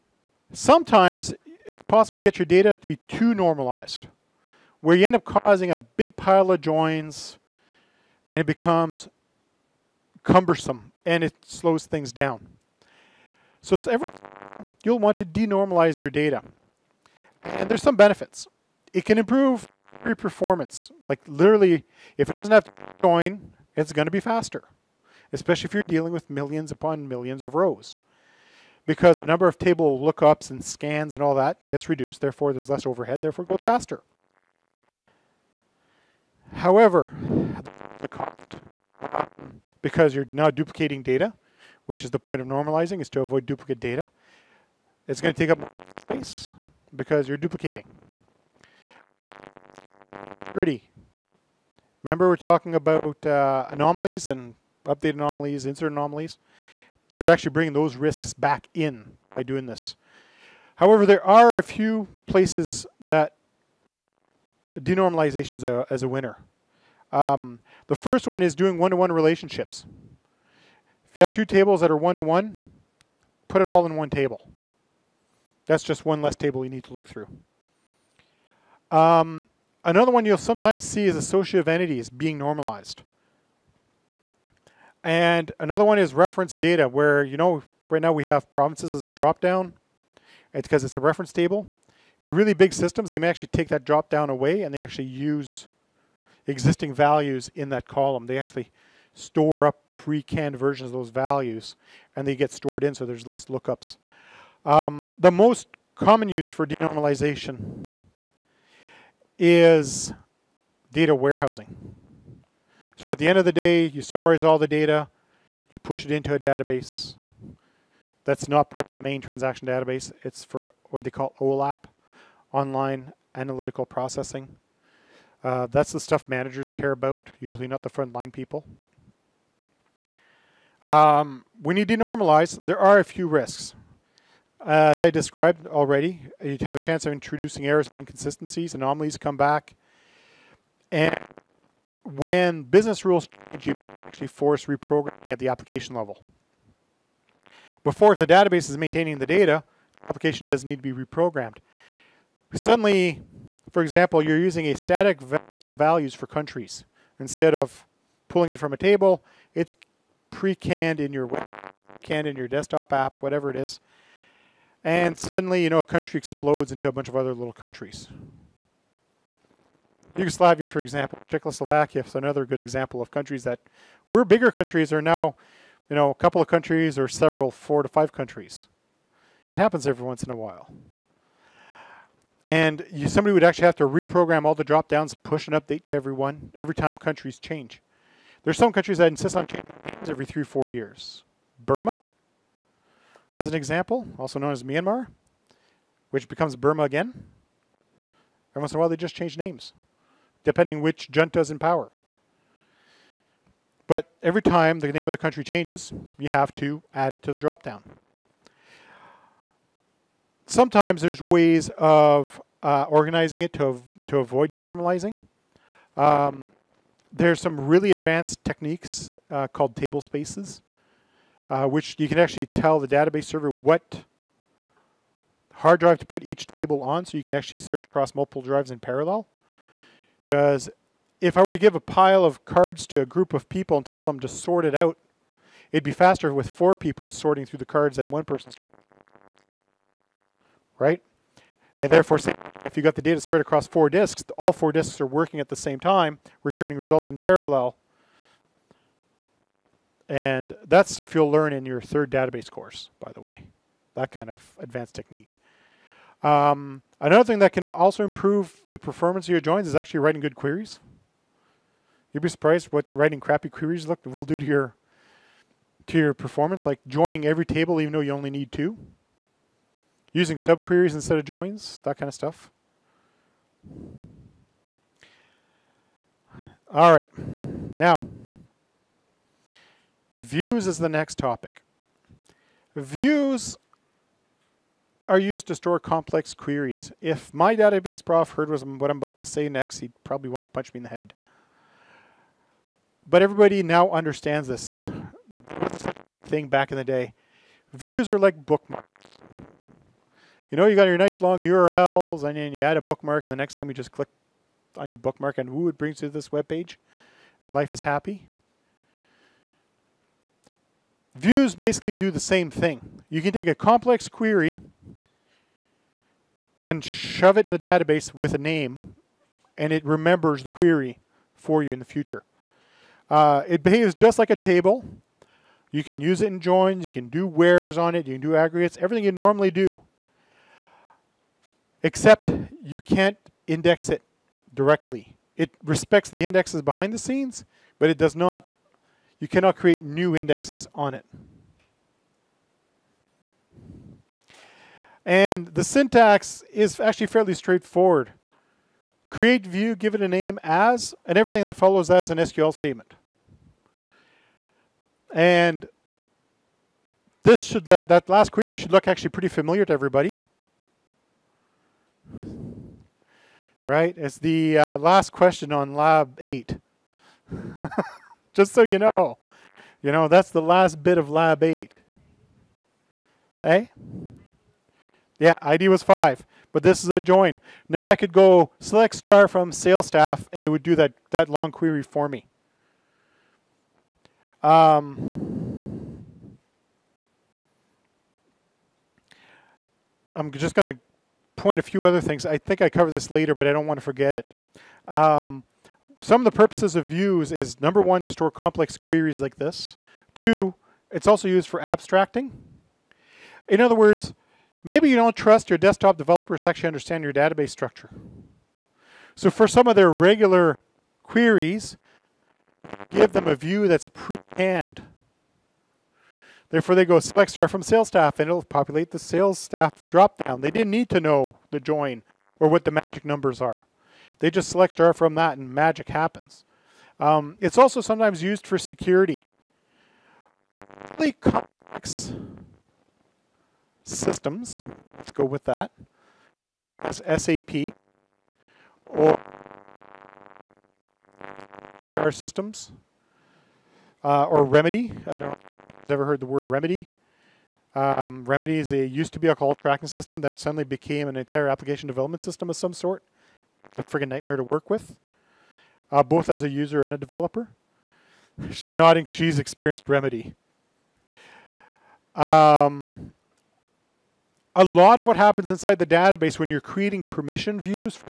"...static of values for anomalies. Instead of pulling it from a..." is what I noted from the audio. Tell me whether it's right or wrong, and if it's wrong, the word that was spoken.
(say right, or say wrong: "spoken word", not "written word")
wrong: "countries", not "anomalies".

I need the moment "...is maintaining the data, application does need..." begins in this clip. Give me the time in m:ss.
2:28.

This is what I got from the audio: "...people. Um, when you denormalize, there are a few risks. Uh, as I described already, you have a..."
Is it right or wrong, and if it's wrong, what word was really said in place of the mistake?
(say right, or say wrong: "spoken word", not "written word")
right.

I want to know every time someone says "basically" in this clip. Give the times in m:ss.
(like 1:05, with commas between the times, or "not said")
5:11.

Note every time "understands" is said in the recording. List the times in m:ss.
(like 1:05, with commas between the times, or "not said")
4:53, 6:46.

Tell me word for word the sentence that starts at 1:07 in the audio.
Um, the first one is doing one-to-one -one relationships.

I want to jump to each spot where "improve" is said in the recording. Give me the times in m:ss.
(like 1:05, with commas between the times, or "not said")
0:19, 4:18.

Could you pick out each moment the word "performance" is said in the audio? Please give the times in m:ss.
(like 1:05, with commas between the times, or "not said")
0:20, 4:18, 4:26.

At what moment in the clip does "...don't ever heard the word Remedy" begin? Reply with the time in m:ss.
7:25.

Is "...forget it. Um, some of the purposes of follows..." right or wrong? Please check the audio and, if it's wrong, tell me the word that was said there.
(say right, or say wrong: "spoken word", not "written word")
wrong: "views", not "follows".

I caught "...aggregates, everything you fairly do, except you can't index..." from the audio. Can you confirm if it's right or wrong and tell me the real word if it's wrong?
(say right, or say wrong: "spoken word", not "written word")
wrong: "normally", not "fairly".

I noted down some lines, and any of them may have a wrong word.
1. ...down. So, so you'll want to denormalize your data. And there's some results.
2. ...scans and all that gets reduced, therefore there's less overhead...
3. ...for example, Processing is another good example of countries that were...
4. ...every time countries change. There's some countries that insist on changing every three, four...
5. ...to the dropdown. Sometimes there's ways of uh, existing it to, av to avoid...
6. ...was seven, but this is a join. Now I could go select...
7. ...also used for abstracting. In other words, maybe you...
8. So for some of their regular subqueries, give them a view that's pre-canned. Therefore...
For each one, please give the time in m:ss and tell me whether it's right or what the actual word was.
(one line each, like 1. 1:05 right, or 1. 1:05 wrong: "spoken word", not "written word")
1. 0:12 wrong: "benefits", not "results"
2. 0:30 right
3. 2:50 wrong: "Czechoslovakia", not "Processing"
4. 3:06 right
5. 3:27 wrong: "organizing", not "existing"
6. 6:15 wrong: "five", not "seven"
7. 6:41 right
8. 6:49 wrong: "queries", not "subqueries".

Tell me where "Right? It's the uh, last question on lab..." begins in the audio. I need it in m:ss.
6:03.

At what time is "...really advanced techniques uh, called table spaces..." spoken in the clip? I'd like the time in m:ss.
3:37.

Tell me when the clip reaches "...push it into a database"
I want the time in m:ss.
1:55.